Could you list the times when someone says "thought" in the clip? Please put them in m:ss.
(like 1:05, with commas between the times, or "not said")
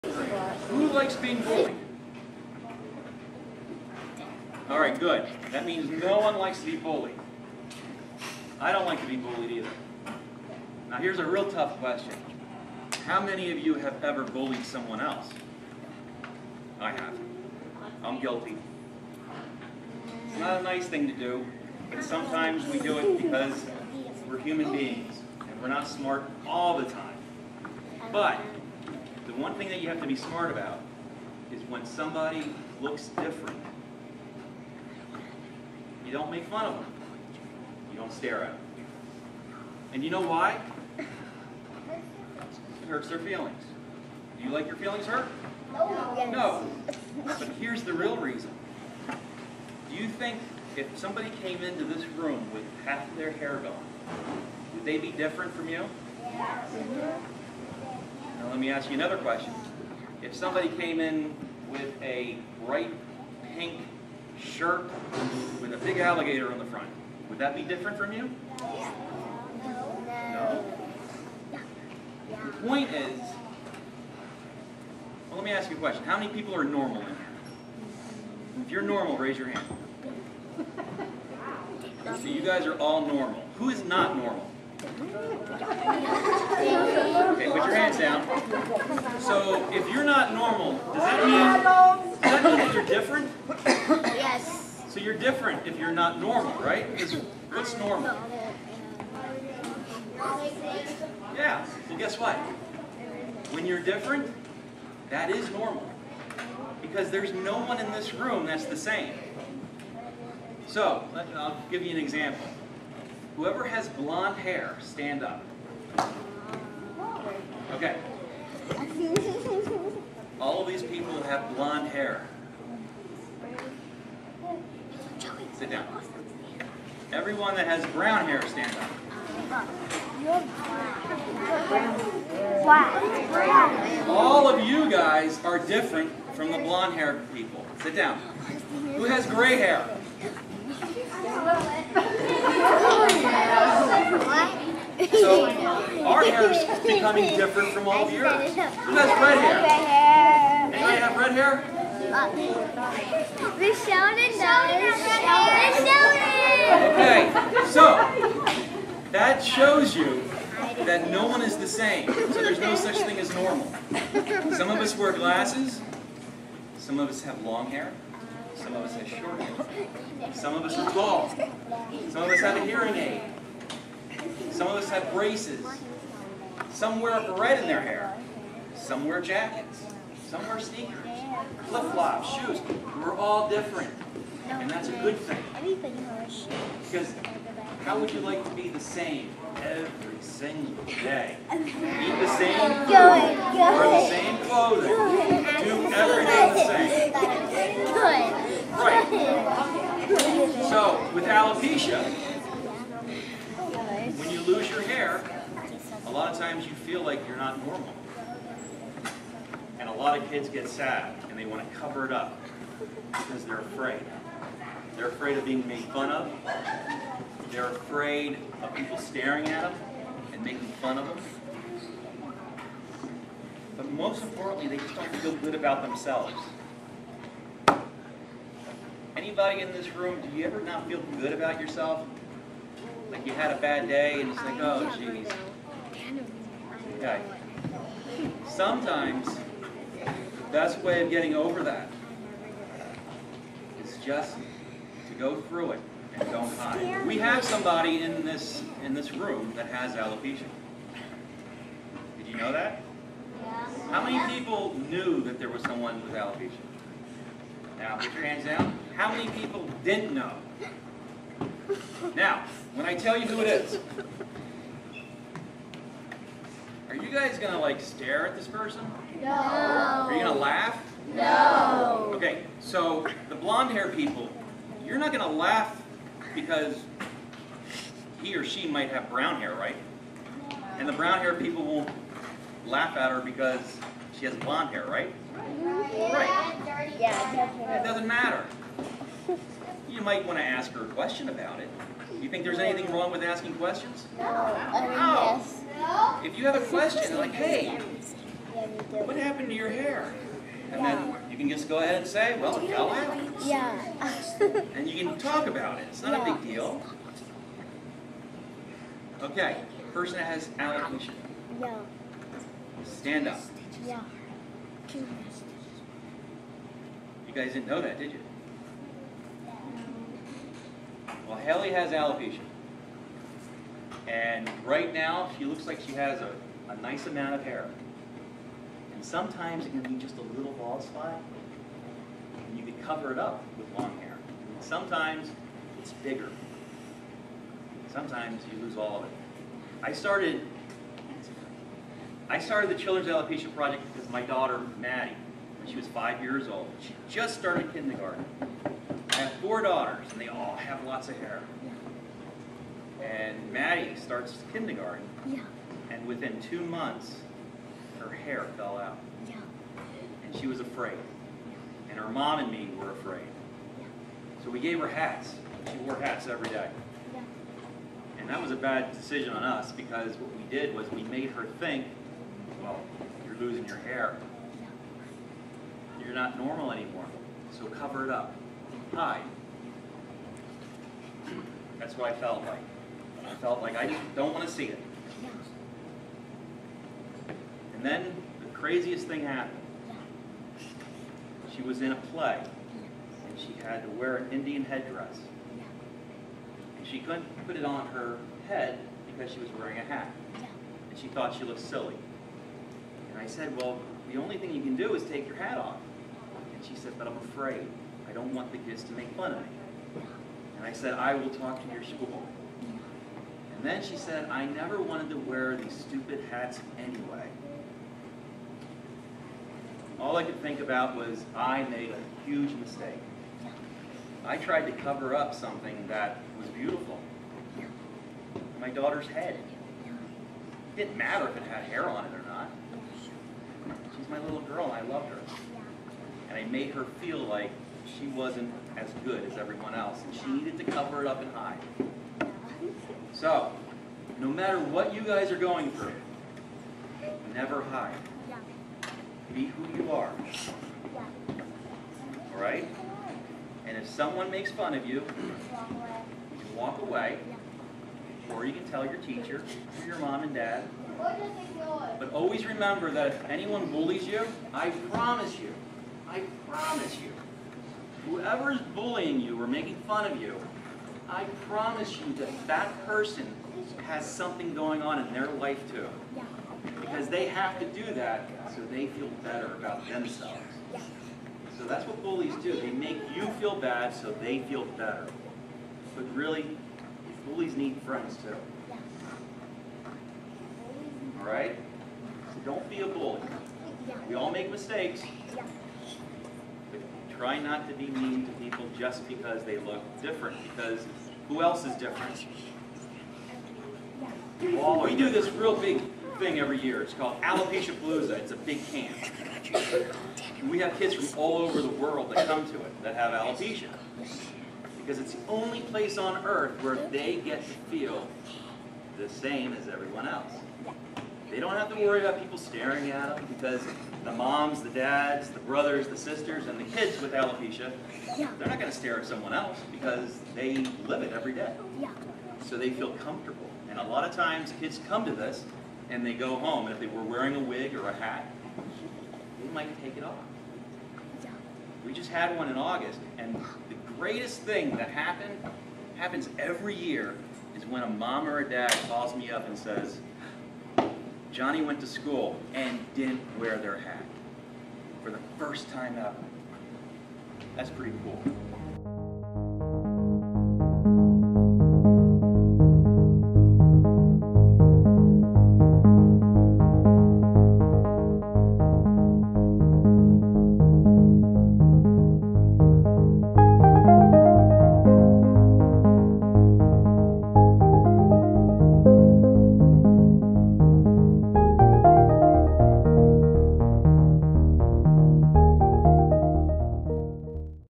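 6:41.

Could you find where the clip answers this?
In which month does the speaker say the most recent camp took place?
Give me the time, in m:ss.
9:02.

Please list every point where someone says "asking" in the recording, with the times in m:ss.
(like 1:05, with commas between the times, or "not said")
4:53.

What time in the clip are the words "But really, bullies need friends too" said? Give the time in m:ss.
8:05.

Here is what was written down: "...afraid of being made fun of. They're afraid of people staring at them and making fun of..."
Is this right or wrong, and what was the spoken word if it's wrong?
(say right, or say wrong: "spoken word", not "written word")
right.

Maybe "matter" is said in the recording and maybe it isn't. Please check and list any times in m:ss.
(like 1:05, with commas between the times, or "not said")
4:48, 7:10, 7:24.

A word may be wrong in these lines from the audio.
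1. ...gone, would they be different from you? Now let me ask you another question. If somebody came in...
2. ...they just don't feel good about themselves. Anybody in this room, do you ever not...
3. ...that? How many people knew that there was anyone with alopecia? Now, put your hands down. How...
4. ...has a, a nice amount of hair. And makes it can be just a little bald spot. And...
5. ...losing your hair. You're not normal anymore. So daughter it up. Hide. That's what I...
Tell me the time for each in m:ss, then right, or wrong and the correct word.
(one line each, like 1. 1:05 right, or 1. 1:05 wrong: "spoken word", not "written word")
1. 0:53 right
2. 3:44 right
3. 4:12 wrong: "someone", not "anyone"
4. 5:25 wrong: "sometimes", not "makes"
5. 6:13 wrong: "cover", not "daughter".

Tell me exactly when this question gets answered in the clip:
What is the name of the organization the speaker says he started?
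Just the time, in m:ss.
5:42.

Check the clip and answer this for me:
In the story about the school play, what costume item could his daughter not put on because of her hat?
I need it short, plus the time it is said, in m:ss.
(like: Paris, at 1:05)
Indian headdress, at 6:34.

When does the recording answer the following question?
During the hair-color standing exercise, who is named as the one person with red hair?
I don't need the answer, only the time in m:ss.
2:33.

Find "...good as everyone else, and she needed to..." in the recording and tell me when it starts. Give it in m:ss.
7:19.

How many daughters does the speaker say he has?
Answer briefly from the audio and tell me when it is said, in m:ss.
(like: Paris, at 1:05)
4, at 5:49.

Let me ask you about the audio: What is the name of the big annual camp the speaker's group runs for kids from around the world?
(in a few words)
Alopecia Palooza.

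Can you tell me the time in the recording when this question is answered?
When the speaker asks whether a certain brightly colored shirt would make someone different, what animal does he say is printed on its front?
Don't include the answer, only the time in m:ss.
1:05.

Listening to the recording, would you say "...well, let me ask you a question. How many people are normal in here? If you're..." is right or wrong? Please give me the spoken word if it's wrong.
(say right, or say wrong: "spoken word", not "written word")
right.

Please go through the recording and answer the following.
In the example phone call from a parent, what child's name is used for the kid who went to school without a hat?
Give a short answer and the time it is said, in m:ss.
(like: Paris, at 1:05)
Johnny, at 9:11.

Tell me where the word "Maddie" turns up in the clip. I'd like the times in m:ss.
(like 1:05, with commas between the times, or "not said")
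5:44, 5:53.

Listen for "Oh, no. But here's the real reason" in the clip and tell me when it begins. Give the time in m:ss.
0:46.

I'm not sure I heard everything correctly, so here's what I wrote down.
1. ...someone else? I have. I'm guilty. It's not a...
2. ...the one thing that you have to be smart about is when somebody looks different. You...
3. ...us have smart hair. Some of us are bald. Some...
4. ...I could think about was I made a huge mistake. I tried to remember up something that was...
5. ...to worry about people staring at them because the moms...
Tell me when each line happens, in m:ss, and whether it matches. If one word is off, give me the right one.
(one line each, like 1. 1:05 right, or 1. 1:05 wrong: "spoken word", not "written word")
1. 0:14 right
2. 0:29 right
3. 2:48 wrong: "short", not "smart"
4. 7:00 wrong: "cover", not "remember"
5. 8:41 right.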